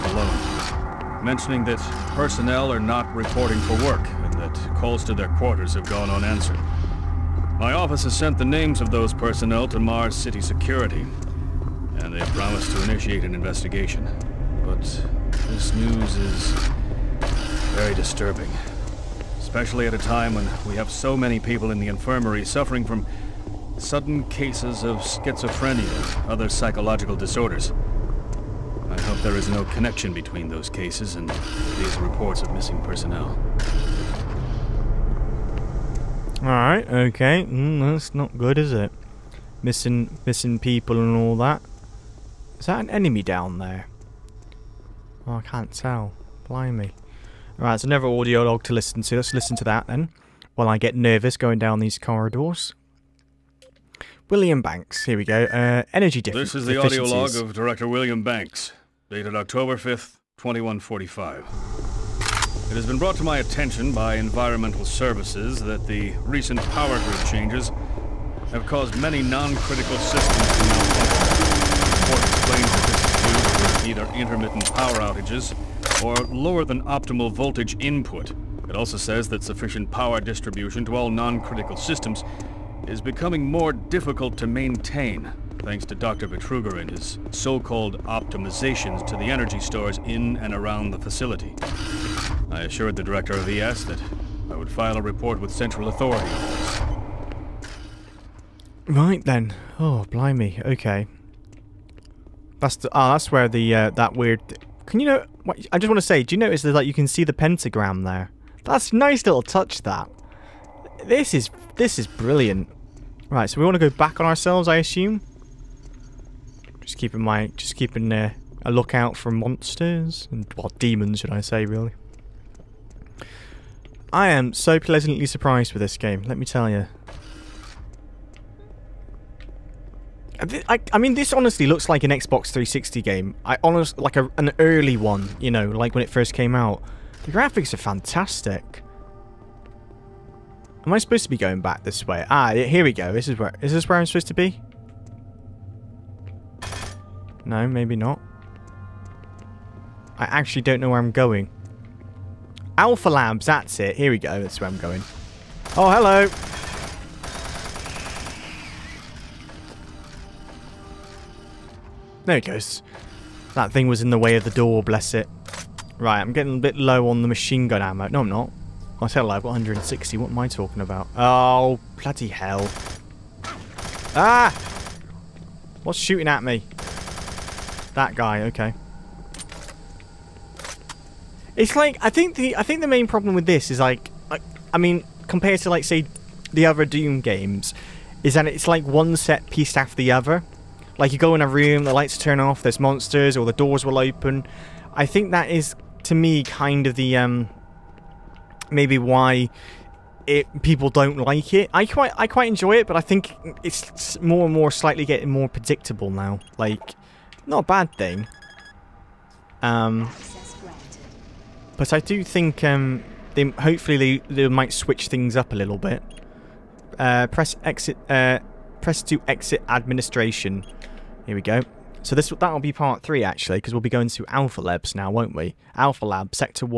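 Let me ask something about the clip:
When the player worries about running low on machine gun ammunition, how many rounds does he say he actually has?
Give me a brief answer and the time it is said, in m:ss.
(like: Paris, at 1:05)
160, at 2:49.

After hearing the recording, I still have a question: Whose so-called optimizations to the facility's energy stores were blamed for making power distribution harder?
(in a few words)
Dr. Betruger.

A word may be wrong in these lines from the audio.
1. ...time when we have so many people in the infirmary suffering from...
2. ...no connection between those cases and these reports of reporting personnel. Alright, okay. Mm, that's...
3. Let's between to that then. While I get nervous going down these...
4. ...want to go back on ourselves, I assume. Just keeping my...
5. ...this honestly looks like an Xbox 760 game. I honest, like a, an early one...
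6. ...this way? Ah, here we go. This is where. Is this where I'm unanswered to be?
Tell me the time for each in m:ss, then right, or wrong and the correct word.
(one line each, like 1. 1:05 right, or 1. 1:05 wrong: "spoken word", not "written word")
1. 0:19 right
2. 0:29 wrong: "missing", not "reporting"
3. 0:49 wrong: "listen", not "between"
4. 1:53 right
5. 2:11 wrong: "360", not "760"
6. 2:21 wrong: "supposed", not "unanswered".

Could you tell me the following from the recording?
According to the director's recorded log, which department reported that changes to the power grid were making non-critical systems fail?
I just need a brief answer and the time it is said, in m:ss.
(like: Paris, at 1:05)
Environmental Services, at 1:04.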